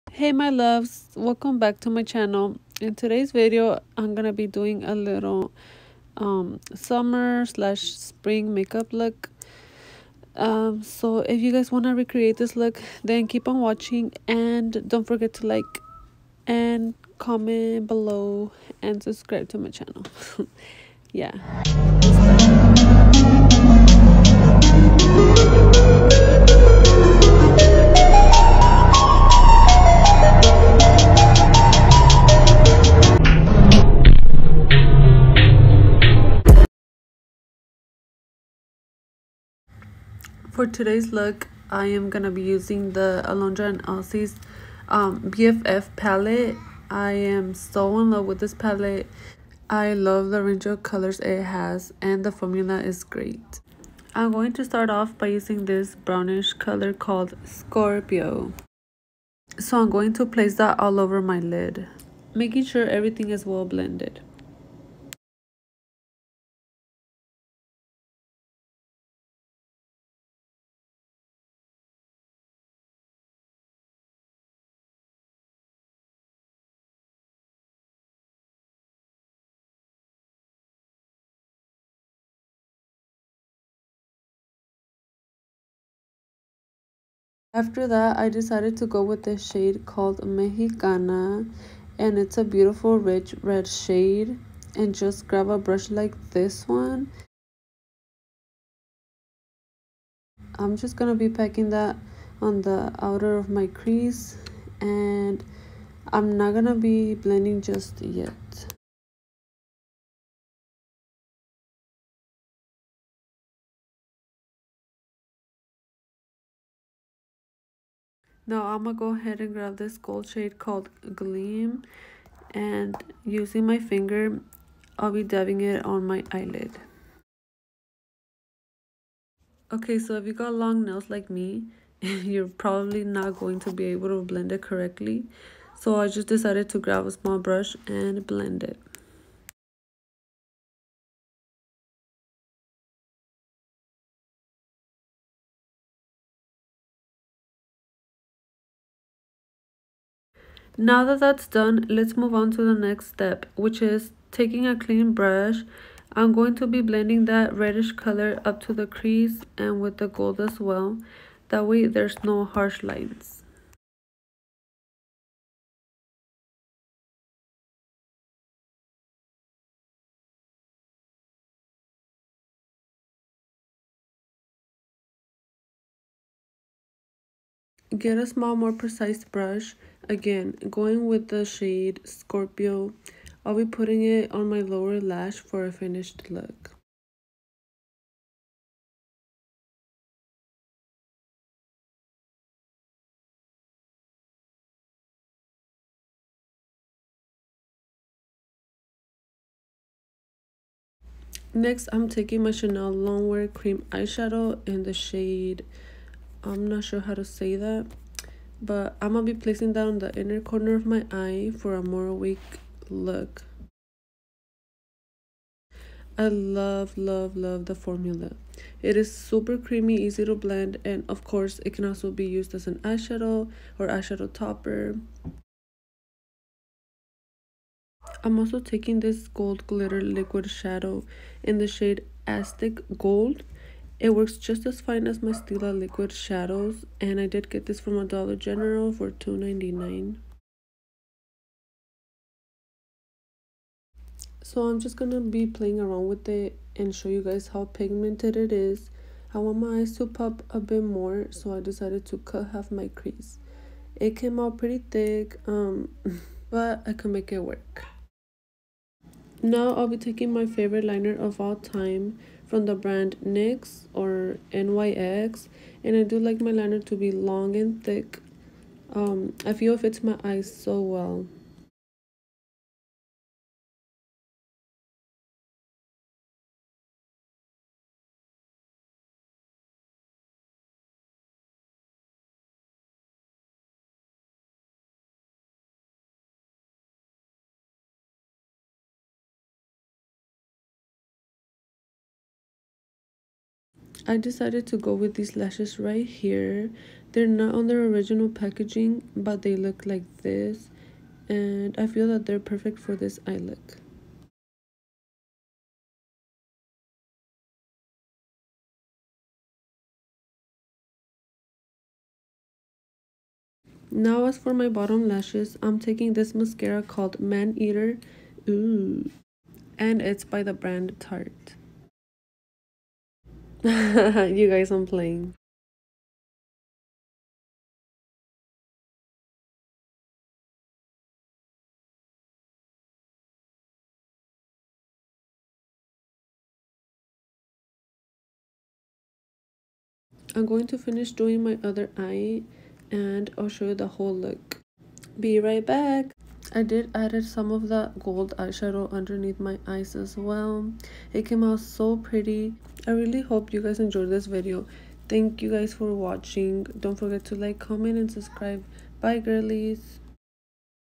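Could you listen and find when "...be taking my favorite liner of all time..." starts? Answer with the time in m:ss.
4:19.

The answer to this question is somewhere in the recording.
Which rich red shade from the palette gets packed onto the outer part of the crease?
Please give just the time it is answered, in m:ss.
1:30.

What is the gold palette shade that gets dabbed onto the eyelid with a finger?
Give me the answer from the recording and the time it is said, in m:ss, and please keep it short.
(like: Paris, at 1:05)
Gleam, at 2:01.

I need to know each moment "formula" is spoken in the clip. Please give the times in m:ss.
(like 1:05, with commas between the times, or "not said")
0:52, 3:37.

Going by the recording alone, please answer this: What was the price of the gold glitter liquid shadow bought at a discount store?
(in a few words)
$2.99.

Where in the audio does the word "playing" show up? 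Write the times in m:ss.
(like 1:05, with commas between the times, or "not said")
4:05, 5:24.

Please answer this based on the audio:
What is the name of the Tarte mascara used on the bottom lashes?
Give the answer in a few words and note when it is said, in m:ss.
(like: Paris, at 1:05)
Maneater, at 5:17.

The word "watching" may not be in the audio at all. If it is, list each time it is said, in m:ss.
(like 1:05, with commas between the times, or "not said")
0:13, 5:55.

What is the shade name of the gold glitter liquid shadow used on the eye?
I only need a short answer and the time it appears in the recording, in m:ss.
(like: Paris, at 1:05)
Aztec Gold, at 3:52.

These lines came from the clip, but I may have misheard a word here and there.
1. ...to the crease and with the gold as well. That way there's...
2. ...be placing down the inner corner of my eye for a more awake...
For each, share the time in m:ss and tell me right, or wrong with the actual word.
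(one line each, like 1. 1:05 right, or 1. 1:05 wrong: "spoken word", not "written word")
1. 2:38 right
2. 3:29 right.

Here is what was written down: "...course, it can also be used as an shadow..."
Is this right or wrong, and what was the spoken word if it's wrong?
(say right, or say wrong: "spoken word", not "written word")
wrong: "eyeshadow", not "shadow".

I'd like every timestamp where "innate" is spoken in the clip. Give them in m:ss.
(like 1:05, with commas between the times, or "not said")
not said.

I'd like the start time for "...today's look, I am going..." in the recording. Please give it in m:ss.
0:40.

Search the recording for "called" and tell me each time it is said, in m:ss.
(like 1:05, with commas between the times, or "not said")
0:56, 1:29, 2:00, 5:16.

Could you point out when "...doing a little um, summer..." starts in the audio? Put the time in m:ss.
0:04.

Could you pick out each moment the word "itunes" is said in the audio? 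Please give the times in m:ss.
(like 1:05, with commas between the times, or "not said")
not said.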